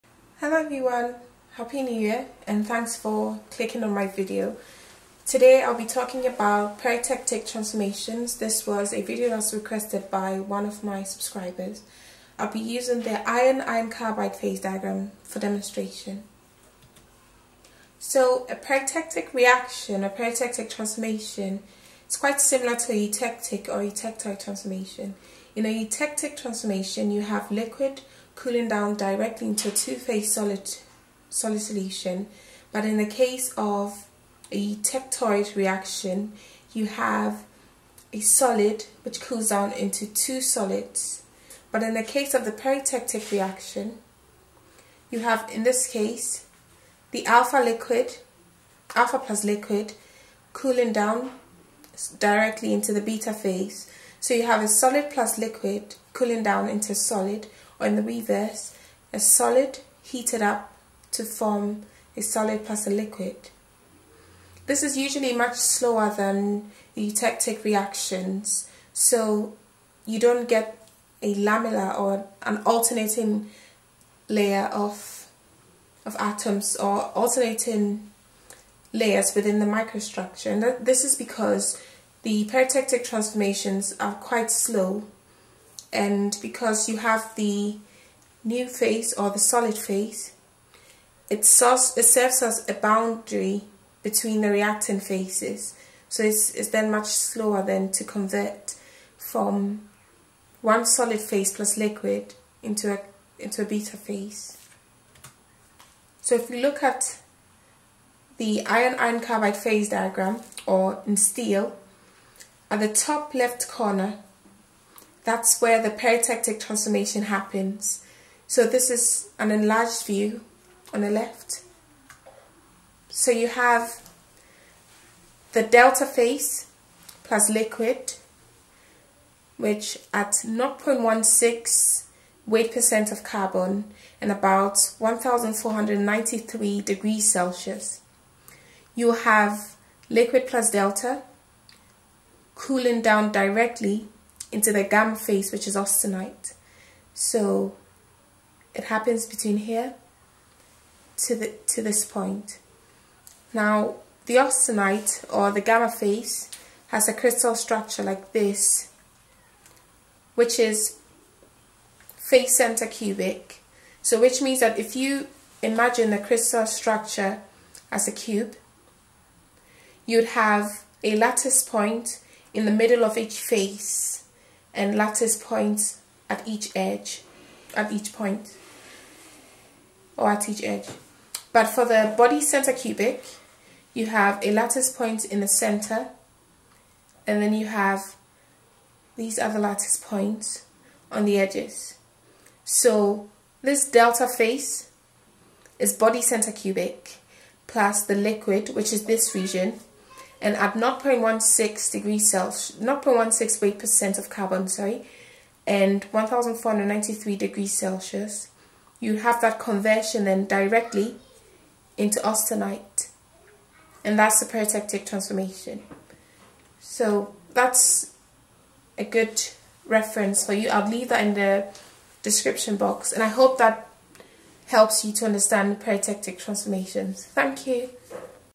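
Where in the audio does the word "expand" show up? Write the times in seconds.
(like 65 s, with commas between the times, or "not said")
not said.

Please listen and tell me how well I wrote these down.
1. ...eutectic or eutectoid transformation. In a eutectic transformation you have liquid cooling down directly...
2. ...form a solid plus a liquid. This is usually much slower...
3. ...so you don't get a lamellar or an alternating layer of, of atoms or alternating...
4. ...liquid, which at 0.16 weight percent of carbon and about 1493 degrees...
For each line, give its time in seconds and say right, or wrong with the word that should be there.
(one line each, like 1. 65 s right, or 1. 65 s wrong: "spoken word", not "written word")
1. 23 s right
2. 61 s right
3. 68 s right
4. 127 s right.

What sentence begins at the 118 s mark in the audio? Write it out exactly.
So this is an enlarged view on the left.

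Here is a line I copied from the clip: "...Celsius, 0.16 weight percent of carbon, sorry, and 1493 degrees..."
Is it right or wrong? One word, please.
right.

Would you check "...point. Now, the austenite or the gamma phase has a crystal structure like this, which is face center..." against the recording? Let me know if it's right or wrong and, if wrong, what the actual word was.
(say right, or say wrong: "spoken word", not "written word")
right.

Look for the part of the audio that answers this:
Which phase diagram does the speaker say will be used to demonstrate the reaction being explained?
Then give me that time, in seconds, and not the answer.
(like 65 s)
13 s.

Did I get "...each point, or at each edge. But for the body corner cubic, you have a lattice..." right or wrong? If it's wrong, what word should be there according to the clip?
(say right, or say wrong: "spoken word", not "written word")
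wrong: "center", not "corner".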